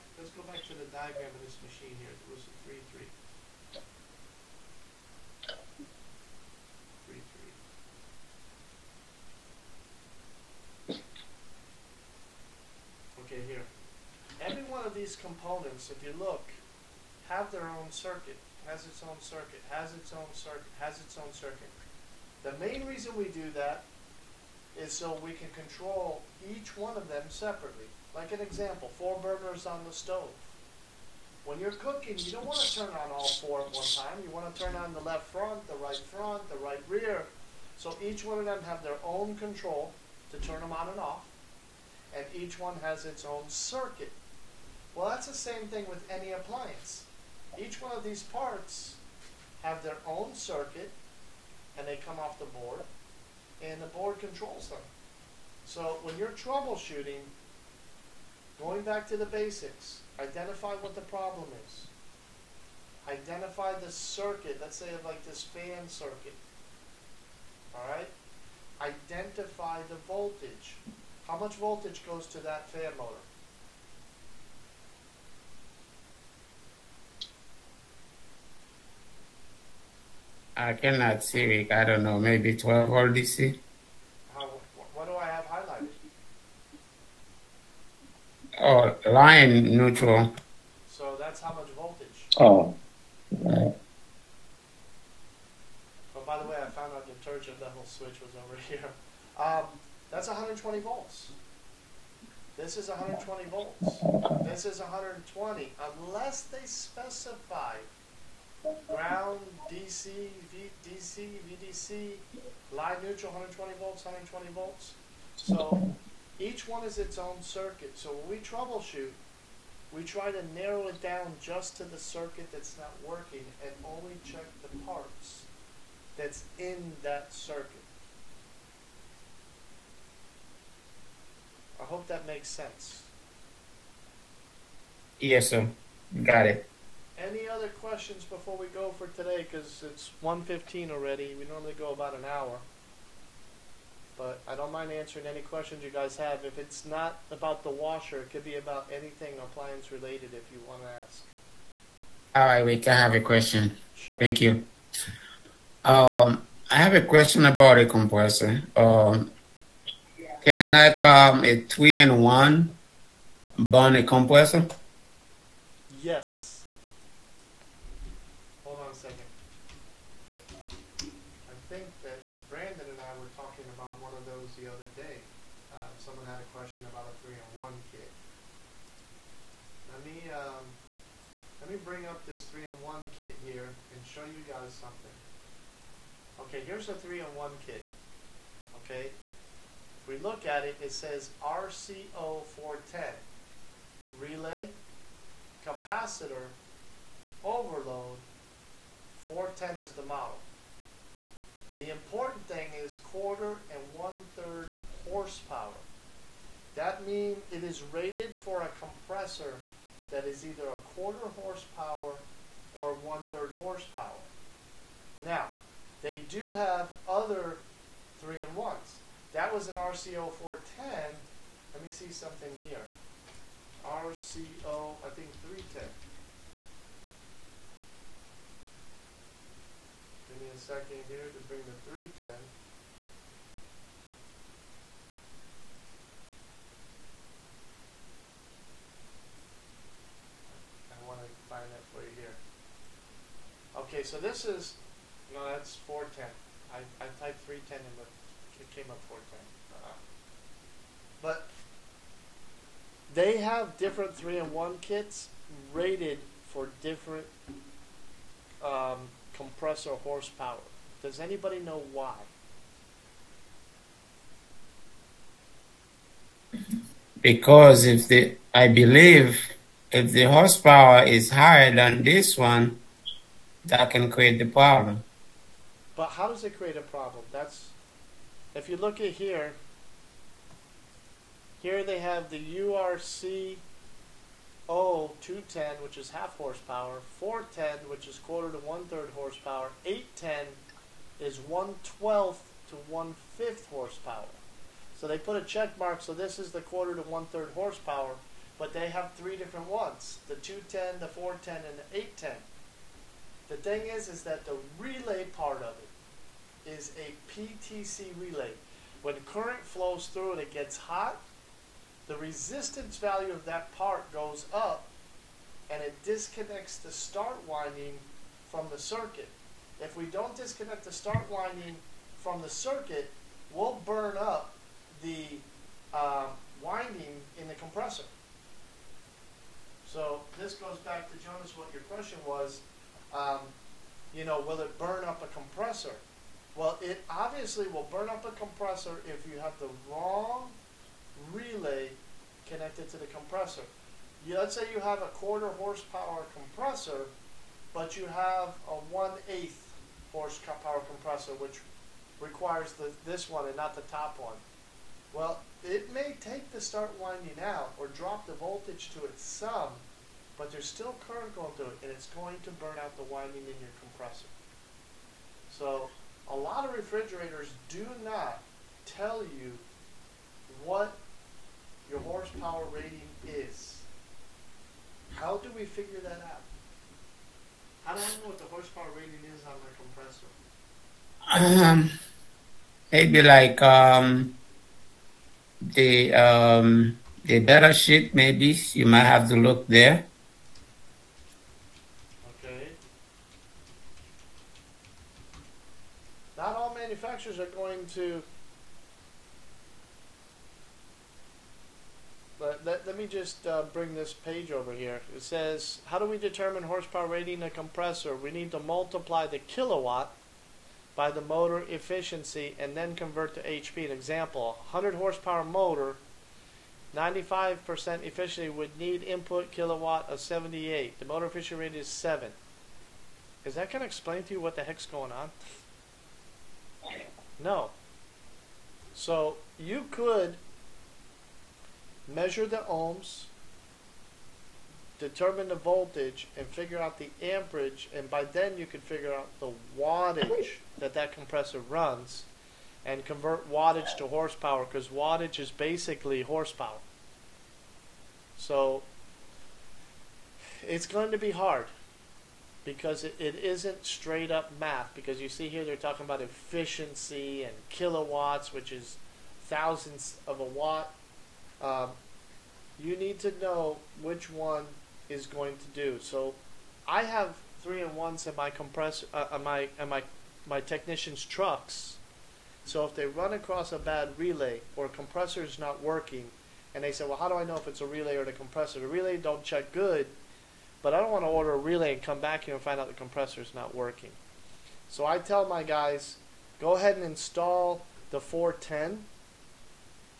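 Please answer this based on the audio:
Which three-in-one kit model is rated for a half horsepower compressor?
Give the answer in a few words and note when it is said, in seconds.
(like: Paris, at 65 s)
URC 210, at 282 s.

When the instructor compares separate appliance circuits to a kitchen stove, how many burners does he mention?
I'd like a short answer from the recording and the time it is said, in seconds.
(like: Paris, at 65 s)
4, at 28 s.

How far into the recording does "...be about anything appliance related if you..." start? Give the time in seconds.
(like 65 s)
148 s.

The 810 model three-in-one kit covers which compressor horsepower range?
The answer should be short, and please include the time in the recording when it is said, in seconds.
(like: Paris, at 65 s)
1/12 to 1/5 horsepower, at 291 s.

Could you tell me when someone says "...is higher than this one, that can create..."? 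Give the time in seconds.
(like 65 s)
271 s.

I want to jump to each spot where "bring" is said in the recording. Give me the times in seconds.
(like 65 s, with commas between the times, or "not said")
231 s, 403 s.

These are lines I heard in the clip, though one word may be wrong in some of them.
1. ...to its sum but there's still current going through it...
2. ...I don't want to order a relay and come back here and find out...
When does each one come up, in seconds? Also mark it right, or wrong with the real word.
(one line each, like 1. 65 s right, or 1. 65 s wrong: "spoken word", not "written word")
1. 358 s right
2. 480 s right.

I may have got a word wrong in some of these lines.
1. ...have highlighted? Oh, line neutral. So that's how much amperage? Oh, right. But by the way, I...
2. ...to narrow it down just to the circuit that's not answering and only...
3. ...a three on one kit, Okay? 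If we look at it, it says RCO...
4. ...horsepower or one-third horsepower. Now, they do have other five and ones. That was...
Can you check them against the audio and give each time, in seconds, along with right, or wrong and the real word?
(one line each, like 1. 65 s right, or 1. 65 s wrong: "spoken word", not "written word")
1. 85 s wrong: "voltage", not "amperage"
2. 120 s wrong: "working", not "answering"
3. 186 s right
4. 211 s wrong: "three", not "five".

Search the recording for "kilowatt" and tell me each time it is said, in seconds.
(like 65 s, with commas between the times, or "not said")
409 s, 419 s, 457 s.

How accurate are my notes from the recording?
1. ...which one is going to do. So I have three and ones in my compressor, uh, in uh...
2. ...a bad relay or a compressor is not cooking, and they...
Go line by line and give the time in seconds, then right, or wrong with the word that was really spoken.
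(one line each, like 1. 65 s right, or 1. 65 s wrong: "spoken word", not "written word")
1. 464 s right
2. 473 s wrong: "working", not "cooking".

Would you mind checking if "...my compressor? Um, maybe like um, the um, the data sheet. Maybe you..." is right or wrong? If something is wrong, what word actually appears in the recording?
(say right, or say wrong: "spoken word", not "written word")
right.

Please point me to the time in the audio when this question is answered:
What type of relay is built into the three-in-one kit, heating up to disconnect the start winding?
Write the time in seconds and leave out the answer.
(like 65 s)
307 s.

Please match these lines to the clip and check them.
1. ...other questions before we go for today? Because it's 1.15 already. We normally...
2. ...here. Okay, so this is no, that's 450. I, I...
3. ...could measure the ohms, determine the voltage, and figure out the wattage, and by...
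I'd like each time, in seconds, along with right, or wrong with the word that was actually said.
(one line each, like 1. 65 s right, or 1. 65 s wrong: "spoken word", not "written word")
1. 137 s right
2. 242 s wrong: "410", not "450"
3. 429 s wrong: "amperage", not "wattage".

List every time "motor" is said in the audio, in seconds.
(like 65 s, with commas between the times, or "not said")
72 s, 411 s, 415 s, 421 s.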